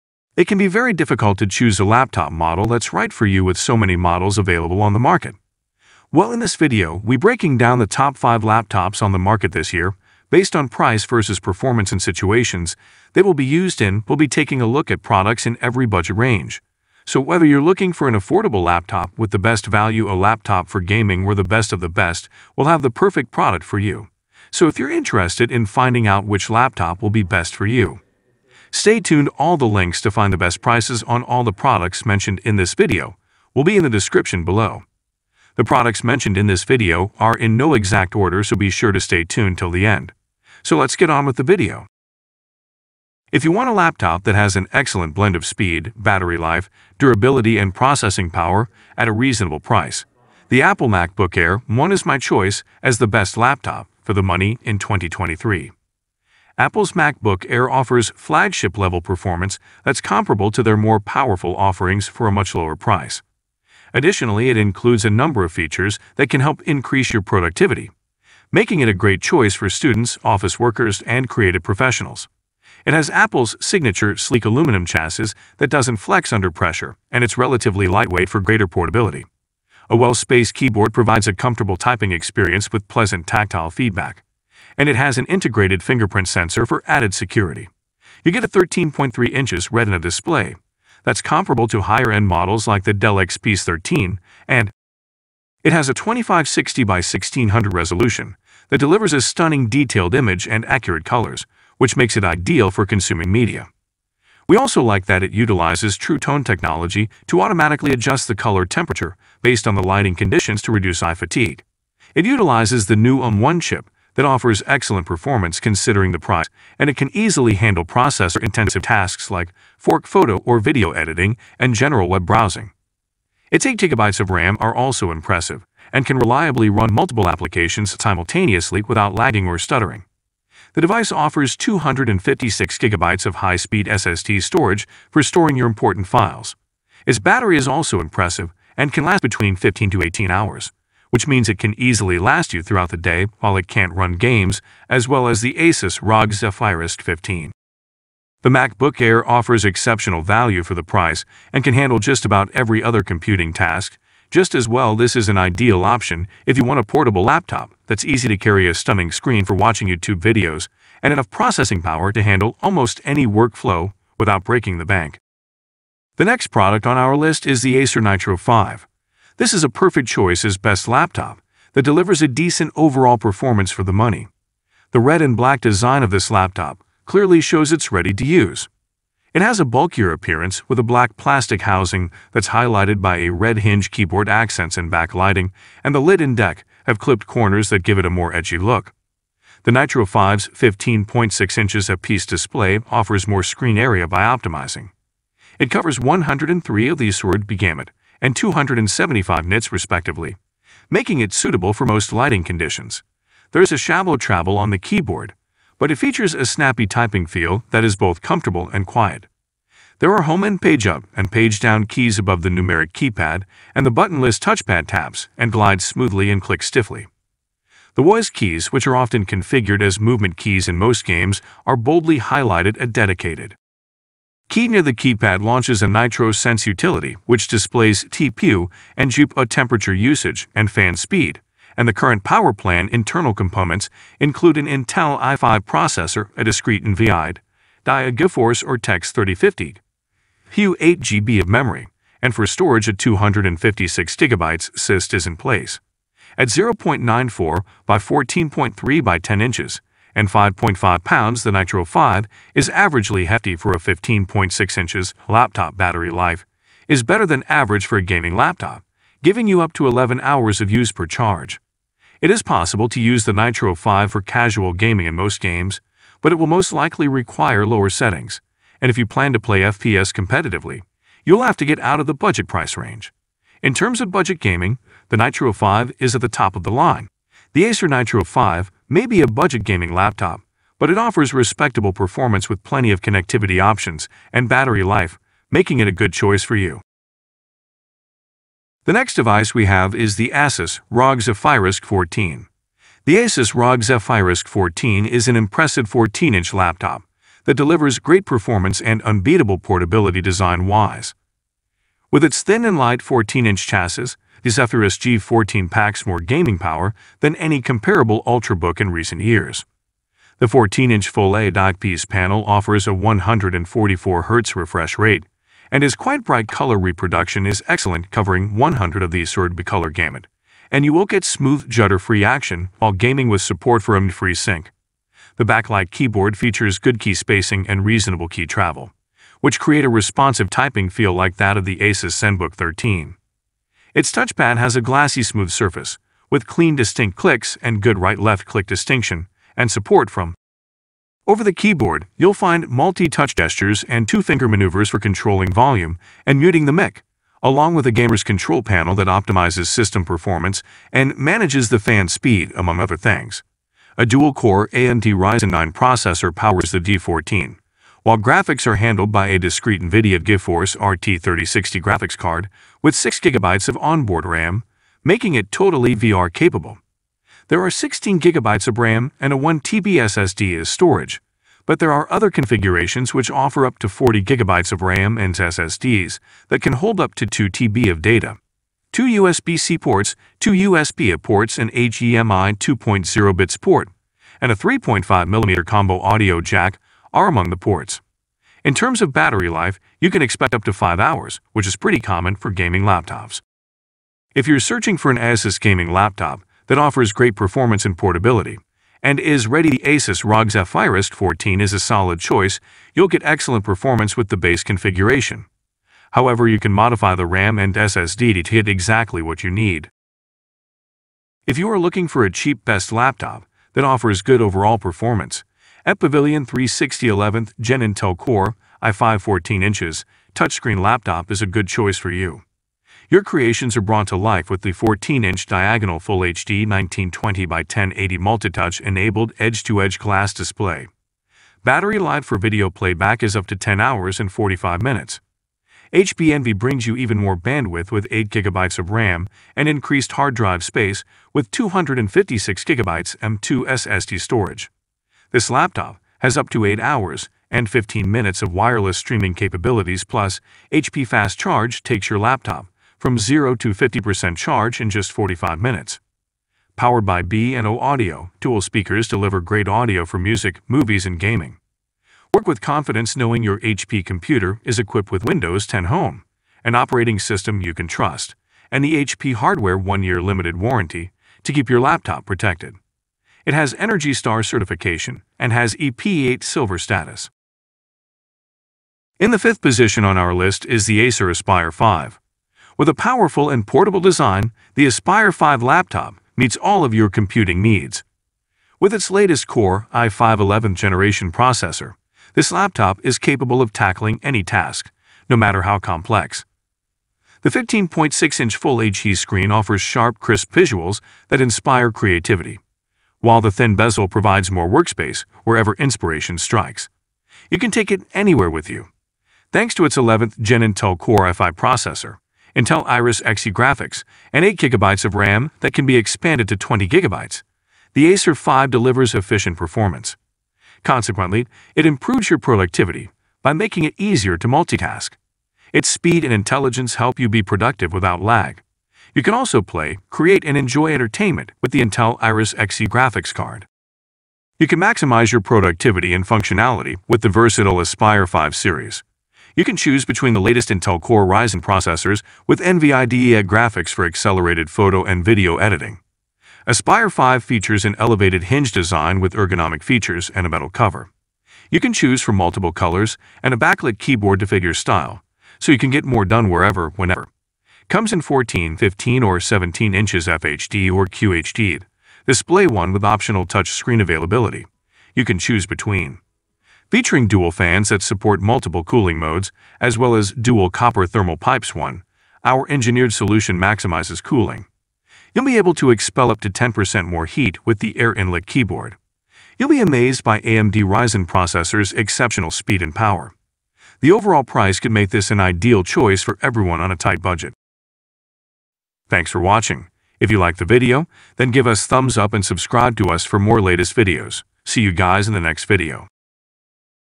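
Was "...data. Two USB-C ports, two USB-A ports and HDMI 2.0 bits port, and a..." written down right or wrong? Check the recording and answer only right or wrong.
right.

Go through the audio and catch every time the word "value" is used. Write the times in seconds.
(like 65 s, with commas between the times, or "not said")
19 s, 150 s.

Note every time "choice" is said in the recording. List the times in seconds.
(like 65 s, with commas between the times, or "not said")
52 s, 69 s, 170 s, 286 s, 402 s, 421 s, 585 s.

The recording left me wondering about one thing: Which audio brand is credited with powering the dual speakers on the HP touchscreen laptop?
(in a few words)
B&O.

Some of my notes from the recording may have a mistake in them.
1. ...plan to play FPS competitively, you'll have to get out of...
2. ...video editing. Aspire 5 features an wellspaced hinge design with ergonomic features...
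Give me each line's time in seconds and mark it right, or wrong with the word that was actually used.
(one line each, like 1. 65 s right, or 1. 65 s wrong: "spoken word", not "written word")
1. 269 s right
2. 545 s wrong: "elevated", not "wellspaced".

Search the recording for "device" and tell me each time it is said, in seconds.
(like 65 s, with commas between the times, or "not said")
130 s, 289 s.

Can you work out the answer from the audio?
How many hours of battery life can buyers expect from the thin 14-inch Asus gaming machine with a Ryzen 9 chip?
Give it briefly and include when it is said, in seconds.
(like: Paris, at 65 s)
5 hours, at 390 s.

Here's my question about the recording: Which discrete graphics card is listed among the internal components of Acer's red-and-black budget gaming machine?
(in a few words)
GeForce RTX 3050.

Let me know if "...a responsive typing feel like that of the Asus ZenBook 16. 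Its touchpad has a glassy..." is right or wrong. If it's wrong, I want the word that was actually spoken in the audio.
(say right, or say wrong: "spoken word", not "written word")
wrong: "13", not "16".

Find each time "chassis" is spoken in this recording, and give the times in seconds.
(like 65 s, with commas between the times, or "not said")
74 s, 303 s.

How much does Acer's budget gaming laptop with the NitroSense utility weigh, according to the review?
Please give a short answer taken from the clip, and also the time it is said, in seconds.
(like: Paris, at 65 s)
5.5 pounds, at 250 s.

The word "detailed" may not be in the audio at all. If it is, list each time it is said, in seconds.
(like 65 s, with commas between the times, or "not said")
99 s.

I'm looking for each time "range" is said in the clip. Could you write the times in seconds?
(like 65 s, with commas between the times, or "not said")
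16 s, 272 s.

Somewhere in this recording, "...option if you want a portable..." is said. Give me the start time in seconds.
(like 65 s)
155 s.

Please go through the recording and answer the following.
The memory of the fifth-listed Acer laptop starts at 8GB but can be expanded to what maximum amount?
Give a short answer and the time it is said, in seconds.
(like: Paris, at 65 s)
20GB, at 516 s.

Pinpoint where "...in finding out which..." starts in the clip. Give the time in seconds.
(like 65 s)
25 s.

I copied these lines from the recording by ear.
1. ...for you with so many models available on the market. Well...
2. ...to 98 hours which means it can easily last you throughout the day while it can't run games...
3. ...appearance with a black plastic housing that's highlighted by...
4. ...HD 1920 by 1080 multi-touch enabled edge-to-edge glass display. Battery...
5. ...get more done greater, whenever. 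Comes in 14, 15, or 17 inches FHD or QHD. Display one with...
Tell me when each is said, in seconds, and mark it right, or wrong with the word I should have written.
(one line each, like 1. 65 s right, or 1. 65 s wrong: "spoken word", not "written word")
1. 3 s right
2. 139 s wrong: "18", not "98"
3. 180 s right
4. 426 s right
5. 555 s wrong: "wherever", not "greater".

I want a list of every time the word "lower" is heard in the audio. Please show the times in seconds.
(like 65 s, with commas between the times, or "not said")
62 s, 267 s.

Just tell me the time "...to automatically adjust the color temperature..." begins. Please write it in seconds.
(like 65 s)
107 s.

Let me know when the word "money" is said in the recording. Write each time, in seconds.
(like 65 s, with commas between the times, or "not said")
54 s, 173 s.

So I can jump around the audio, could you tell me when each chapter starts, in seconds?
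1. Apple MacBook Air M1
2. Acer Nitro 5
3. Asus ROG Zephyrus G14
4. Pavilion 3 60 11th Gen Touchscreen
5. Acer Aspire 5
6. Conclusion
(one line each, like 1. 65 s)
1. 42 s
2. 165 s
3. 291 s
4. 410 s
5. 423 s
6. 589 s.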